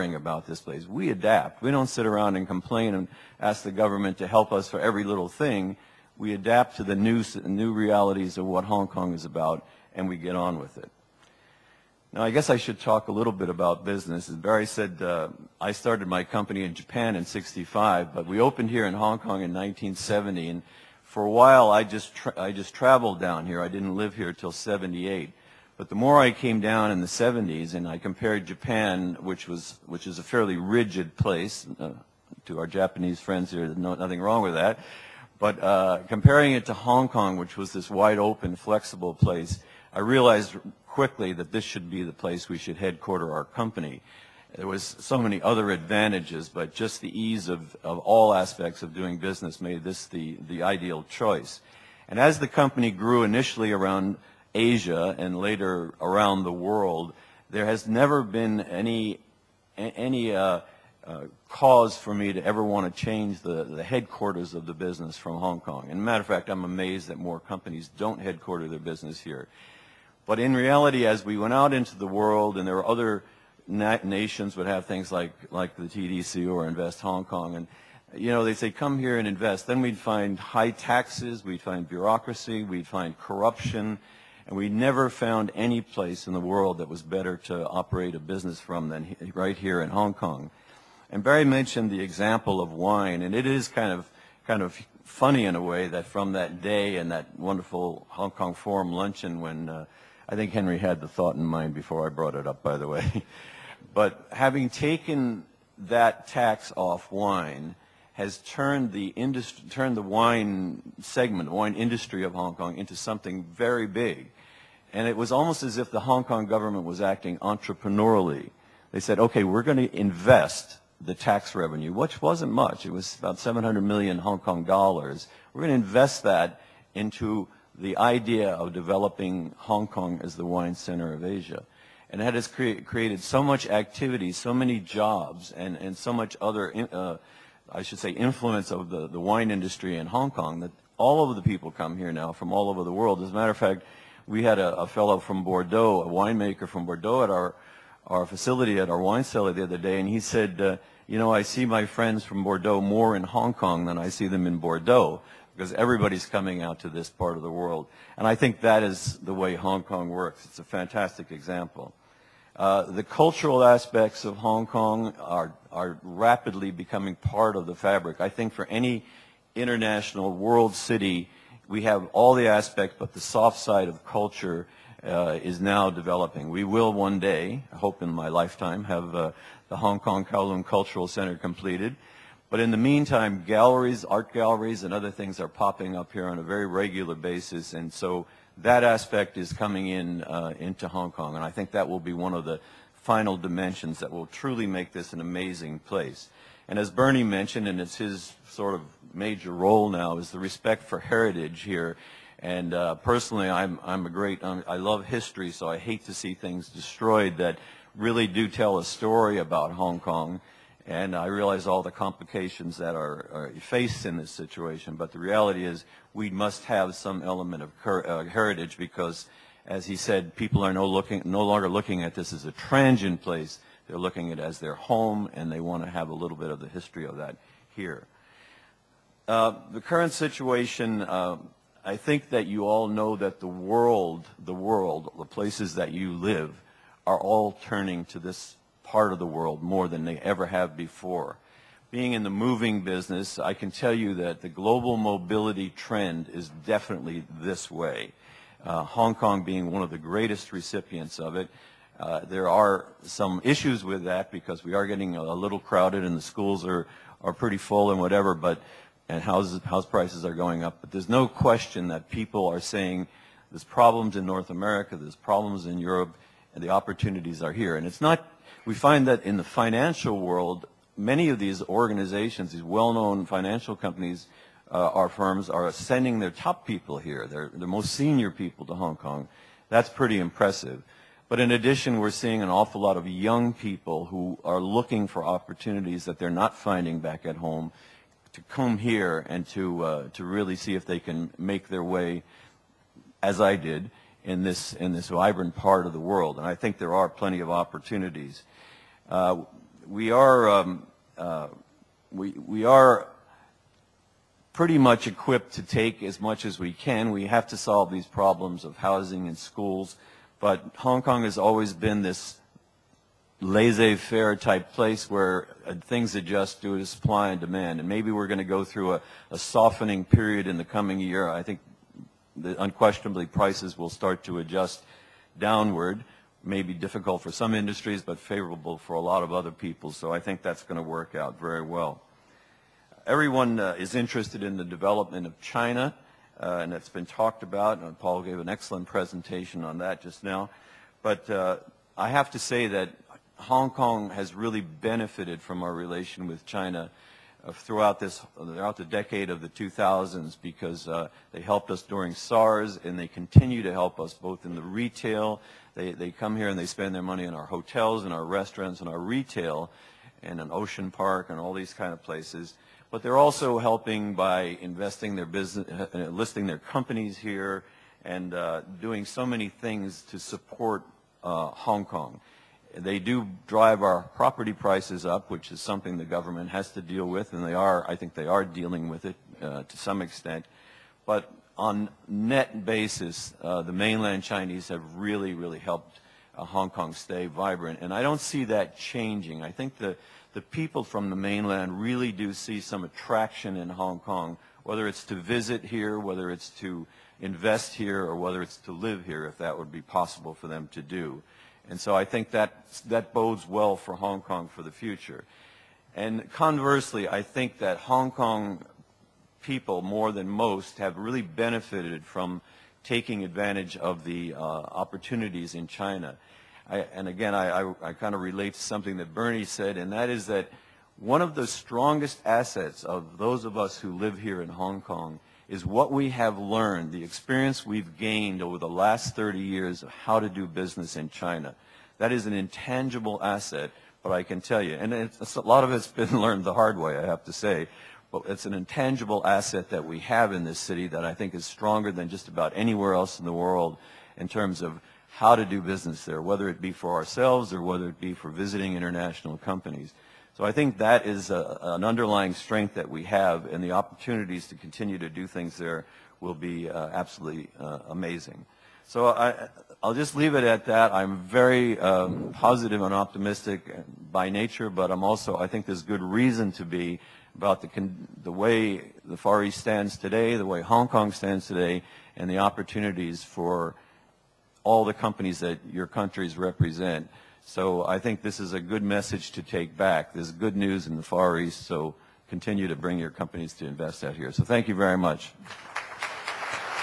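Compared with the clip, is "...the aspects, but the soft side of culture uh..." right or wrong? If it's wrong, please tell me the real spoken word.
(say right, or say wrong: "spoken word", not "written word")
right.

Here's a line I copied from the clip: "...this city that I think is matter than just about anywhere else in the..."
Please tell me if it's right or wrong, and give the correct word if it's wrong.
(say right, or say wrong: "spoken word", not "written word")
wrong: "stronger", not "matter".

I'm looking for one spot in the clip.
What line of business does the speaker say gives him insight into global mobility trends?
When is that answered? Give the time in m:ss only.
4:02.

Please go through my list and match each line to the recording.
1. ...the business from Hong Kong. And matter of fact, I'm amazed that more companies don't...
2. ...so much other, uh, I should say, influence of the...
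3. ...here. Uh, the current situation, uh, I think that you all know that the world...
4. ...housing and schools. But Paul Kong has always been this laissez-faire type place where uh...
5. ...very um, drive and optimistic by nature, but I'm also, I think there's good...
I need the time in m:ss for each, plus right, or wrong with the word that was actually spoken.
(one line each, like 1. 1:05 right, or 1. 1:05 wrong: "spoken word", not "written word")
1. 1:04 right
2. 2:15 right
3. 3:47 right
4. 5:08 wrong: "Hong", not "Paul"
5. 7:41 wrong: "positive", not "drive".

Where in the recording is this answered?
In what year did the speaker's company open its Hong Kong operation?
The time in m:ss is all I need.
0:19.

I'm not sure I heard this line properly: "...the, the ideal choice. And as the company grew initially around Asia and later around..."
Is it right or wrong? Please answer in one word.
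right.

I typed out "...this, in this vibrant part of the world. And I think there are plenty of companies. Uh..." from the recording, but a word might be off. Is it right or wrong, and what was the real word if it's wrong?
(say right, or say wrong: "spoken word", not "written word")
wrong: "opportunities", not "companies".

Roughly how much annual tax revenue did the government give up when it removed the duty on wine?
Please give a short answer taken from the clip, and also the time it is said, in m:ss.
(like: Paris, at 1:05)
700 million Hong Kong dollars, at 2:03.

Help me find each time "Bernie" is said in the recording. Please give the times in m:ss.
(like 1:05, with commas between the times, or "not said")
3:16, 6:59.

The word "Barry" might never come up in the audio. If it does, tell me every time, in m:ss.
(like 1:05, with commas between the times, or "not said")
0:14, 1:31.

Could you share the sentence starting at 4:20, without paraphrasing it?
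But there's no question that people are saying there's problems in North America, there's problems in Europe, and the opportunities are here.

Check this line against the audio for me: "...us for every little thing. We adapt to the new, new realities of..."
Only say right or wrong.
right.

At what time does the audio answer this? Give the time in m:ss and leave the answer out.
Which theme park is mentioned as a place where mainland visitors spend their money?
6:00.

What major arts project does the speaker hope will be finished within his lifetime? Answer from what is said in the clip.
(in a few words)
Hong Kong Kowloon Cultural Center.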